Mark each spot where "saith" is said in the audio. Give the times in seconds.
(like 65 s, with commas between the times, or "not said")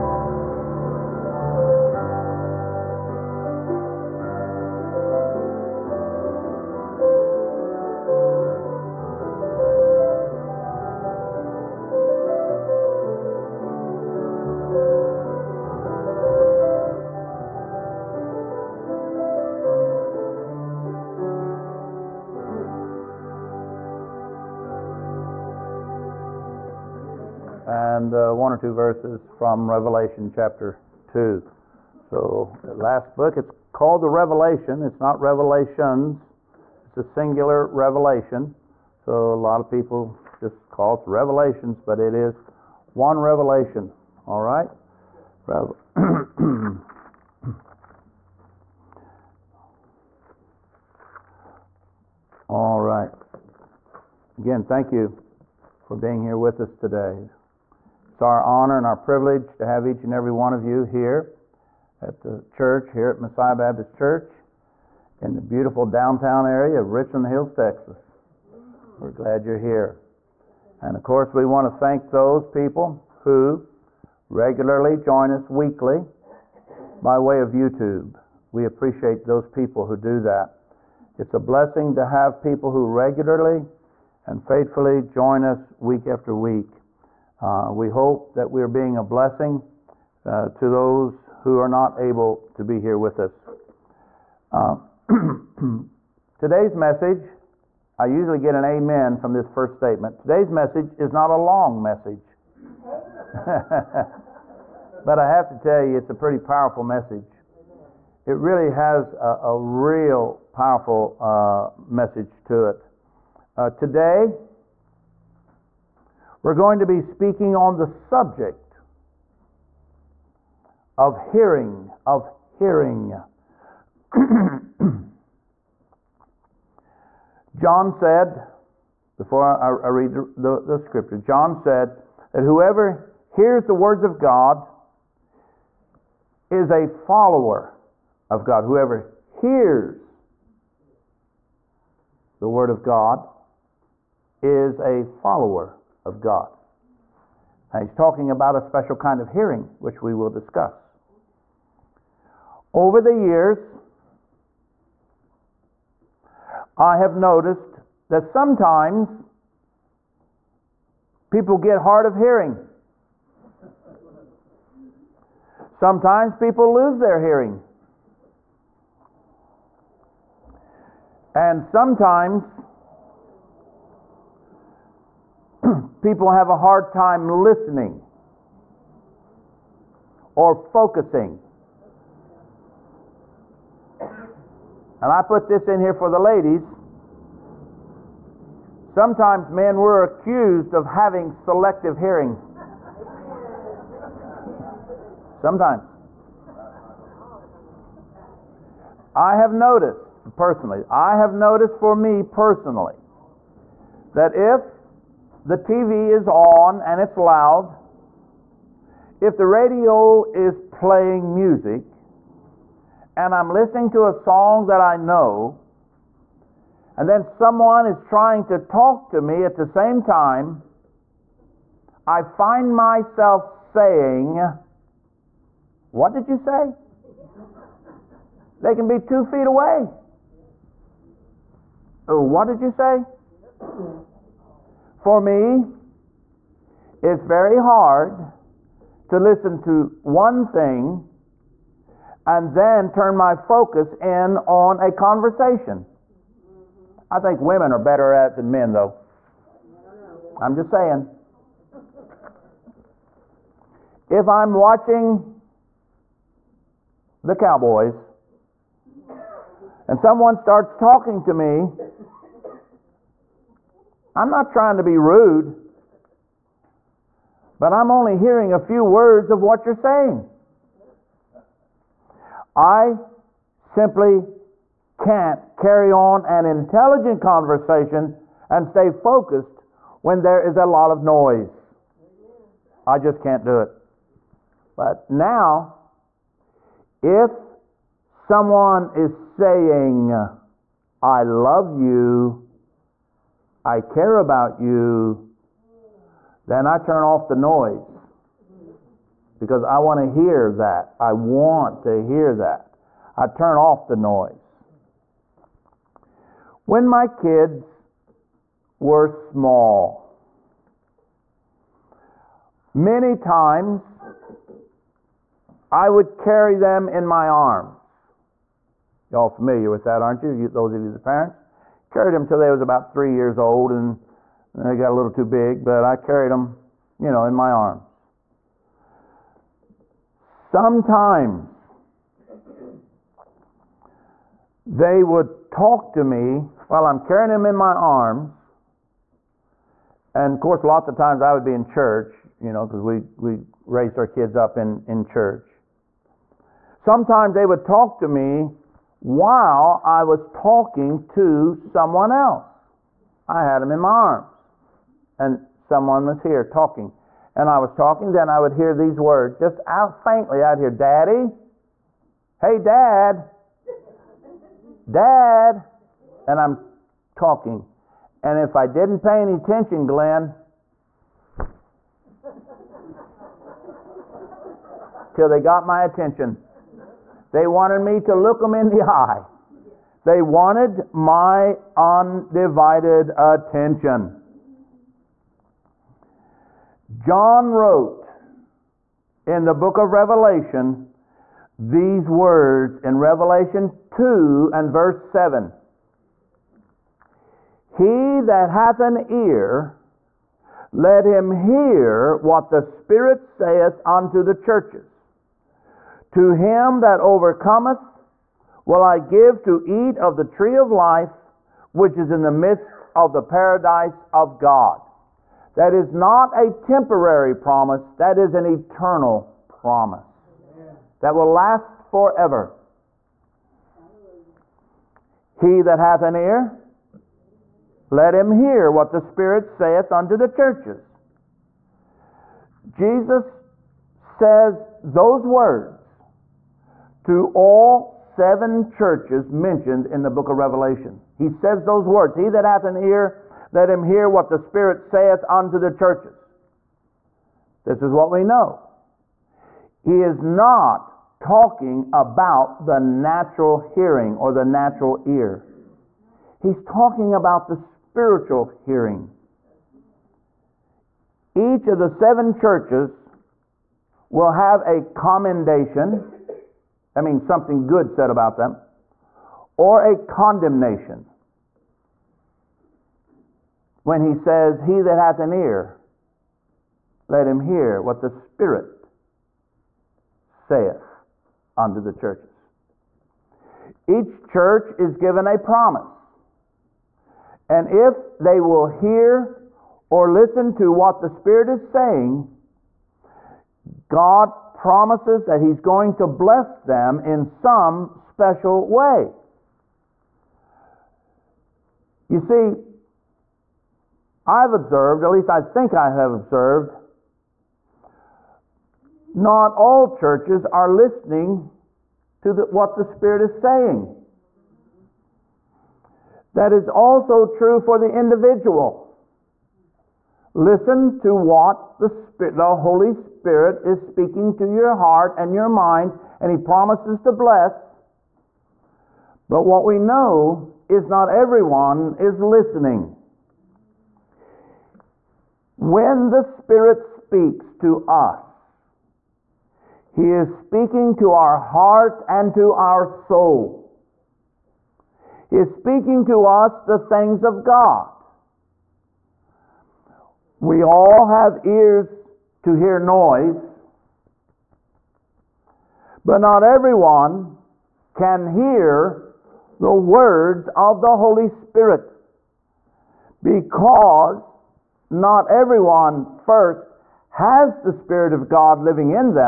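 403 s, 429 s, 444 s, 480 s.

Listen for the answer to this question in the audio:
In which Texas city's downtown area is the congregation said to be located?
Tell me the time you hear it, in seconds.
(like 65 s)
66 s.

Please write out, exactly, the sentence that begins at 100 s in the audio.
Today's message is not a long message.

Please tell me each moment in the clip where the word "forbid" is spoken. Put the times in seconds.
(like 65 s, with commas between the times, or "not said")
not said.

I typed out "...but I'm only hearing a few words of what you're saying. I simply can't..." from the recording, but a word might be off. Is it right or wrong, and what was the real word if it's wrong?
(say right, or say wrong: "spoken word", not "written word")
right.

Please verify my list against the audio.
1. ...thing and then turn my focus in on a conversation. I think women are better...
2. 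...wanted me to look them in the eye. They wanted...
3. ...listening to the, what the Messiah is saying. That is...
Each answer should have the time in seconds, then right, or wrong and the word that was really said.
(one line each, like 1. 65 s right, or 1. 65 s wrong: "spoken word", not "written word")
1. 240 s right
2. 377 s right
3. 510 s wrong: "Spirit", not "Messiah".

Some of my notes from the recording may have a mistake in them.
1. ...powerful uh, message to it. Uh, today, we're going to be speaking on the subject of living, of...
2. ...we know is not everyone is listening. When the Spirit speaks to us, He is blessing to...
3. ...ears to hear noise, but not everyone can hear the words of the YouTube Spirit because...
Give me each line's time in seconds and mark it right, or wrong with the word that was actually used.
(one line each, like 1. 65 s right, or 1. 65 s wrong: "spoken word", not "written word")
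1. 110 s wrong: "hearing", not "living"
2. 529 s wrong: "speaking", not "blessing"
3. 551 s wrong: "Holy", not "YouTube".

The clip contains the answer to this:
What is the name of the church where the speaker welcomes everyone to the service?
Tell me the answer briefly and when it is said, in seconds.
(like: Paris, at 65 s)
Messiah Baptist Church, at 63 s.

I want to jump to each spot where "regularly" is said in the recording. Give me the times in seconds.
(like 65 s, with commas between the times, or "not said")
74 s, 82 s.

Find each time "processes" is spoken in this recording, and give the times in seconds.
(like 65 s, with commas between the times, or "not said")
not said.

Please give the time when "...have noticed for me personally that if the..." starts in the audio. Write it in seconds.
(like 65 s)
201 s.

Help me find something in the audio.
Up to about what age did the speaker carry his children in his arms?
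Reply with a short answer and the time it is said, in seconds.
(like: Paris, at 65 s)
3, at 322 s.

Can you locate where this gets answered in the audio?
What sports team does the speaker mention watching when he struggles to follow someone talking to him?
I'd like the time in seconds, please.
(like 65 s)
257 s.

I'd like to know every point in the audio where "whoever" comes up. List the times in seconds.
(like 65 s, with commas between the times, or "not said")
132 s, 138 s.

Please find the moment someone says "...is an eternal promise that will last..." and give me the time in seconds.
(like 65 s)
418 s.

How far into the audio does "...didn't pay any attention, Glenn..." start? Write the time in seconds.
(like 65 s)
368 s.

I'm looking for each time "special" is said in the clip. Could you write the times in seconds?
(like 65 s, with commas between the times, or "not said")
148 s, 497 s.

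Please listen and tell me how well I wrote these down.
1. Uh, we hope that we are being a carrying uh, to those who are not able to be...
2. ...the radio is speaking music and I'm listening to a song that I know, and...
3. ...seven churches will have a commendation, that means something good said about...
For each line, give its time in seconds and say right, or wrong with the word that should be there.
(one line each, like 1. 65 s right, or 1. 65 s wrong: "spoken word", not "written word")
1. 87 s wrong: "blessing", not "carrying"
2. 209 s wrong: "playing", not "speaking"
3. 461 s right.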